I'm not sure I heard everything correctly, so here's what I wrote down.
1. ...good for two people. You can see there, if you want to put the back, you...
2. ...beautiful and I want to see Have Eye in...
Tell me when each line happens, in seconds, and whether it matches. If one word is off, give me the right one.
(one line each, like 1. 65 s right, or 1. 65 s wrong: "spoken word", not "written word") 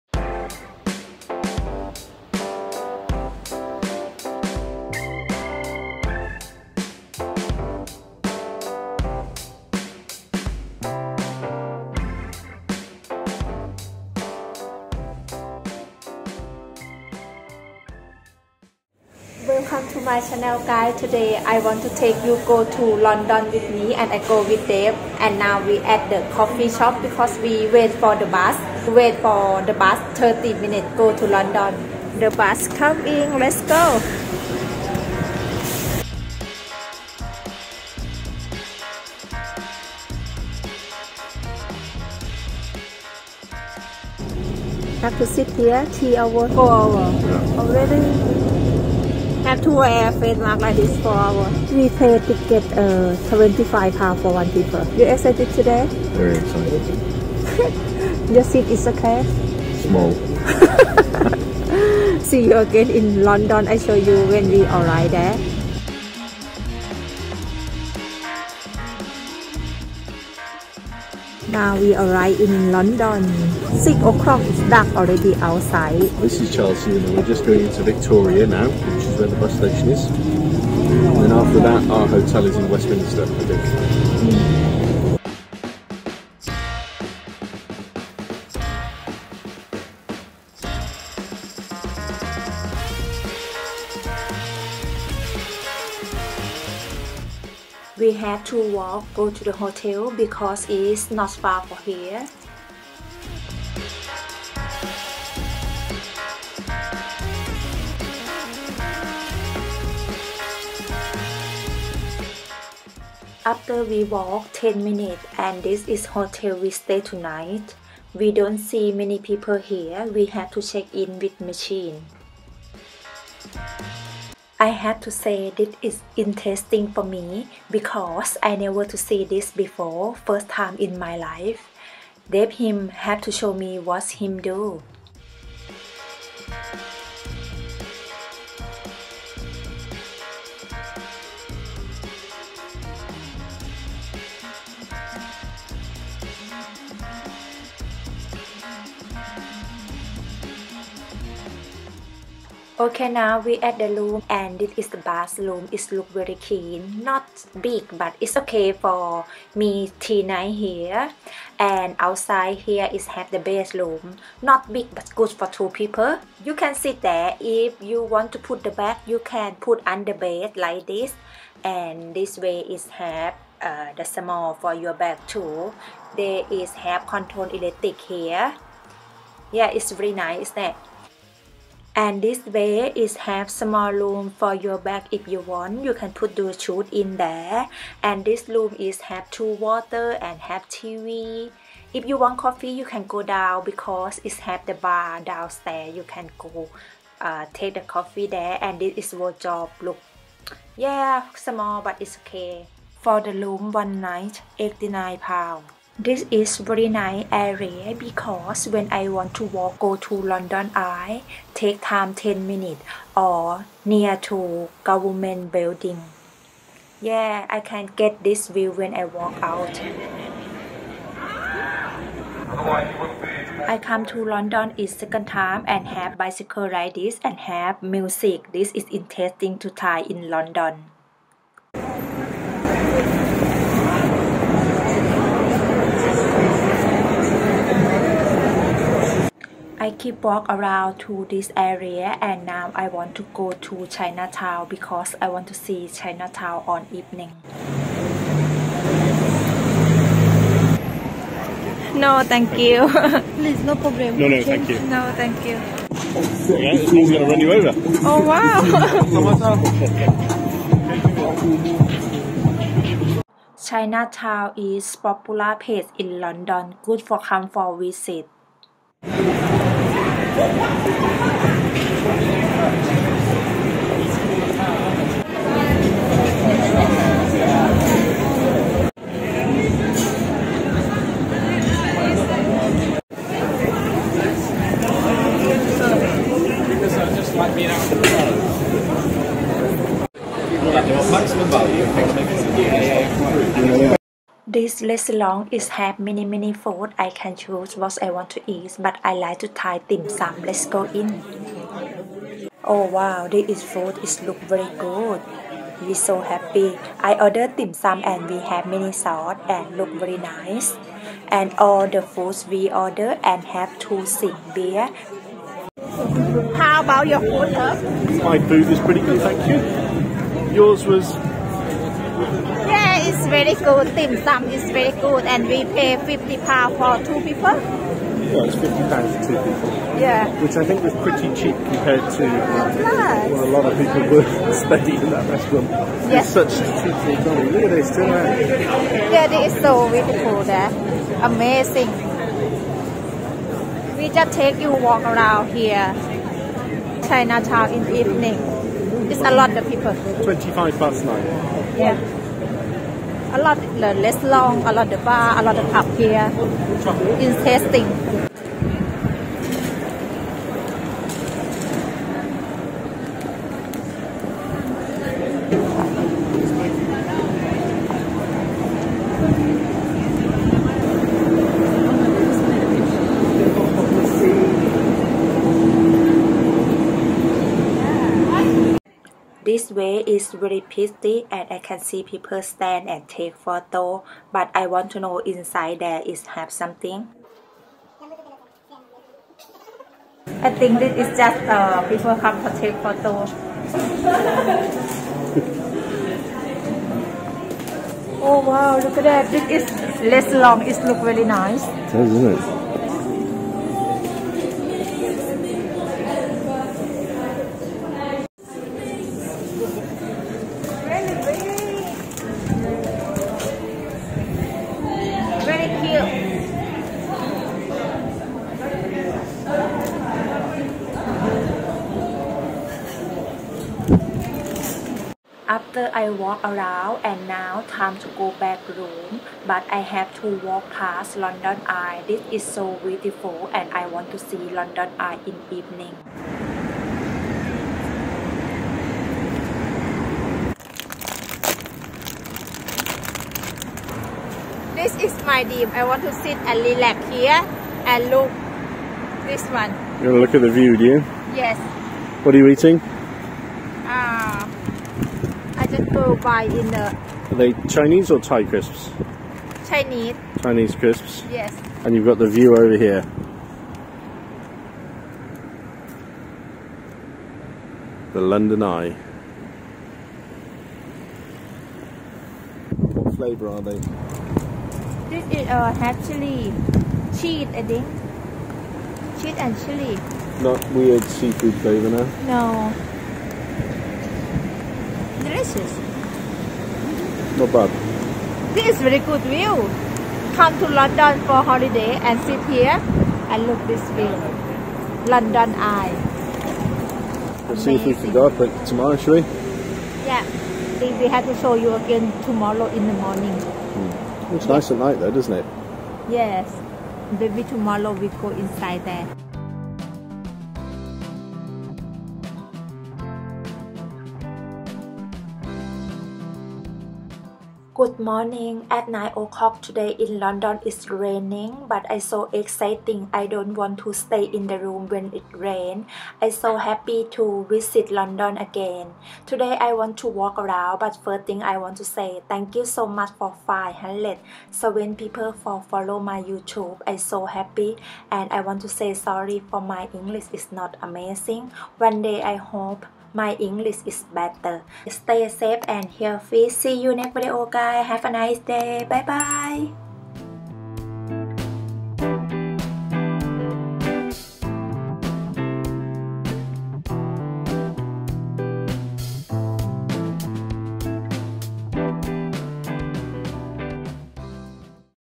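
1. 165 s right
2. 432 s wrong: "London", not "Have".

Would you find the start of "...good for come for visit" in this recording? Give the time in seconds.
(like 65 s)
266 s.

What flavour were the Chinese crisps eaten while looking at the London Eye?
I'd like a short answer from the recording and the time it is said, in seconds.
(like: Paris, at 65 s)
Cheese and chili, at 479 s.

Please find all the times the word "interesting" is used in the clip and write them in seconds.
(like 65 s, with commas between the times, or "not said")
126 s, 228 s, 357 s.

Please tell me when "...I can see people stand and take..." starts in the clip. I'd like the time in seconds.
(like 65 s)
381 s.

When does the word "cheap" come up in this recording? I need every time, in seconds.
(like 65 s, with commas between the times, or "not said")
331 s, 336 s.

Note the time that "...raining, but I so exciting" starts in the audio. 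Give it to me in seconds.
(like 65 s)
520 s.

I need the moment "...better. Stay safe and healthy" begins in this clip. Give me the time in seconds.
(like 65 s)
544 s.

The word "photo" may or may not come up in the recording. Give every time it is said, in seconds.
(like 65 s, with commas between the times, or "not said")
383 s, 392 s.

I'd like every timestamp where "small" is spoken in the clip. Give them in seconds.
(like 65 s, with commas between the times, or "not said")
59 s, 174 s, 183 s, 201 s.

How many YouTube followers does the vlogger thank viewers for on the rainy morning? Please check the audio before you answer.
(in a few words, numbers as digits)
500.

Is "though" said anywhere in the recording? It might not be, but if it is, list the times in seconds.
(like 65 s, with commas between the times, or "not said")
504 s.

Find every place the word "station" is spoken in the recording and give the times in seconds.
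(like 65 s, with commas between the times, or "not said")
79 s.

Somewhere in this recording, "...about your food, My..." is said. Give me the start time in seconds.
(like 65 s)
316 s.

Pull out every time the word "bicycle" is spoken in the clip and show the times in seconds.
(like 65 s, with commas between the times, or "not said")
226 s.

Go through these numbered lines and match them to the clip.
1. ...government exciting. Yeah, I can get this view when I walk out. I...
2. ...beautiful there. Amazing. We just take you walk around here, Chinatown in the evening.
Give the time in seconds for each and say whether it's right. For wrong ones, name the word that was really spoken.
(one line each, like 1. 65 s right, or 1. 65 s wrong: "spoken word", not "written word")
1. 214 s wrong: "building", not "exciting"
2. 339 s right.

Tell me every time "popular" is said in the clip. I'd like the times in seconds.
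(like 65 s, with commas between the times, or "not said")
264 s.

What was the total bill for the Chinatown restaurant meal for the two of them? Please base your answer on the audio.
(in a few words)
50 pounds.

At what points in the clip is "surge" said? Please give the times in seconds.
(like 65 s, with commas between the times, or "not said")
not said.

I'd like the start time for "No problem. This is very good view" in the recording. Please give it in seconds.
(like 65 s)
487 s.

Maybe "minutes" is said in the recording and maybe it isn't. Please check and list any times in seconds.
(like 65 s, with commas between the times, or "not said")
30 s, 114 s, 212 s.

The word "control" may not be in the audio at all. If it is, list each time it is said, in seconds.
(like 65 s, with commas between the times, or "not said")
177 s.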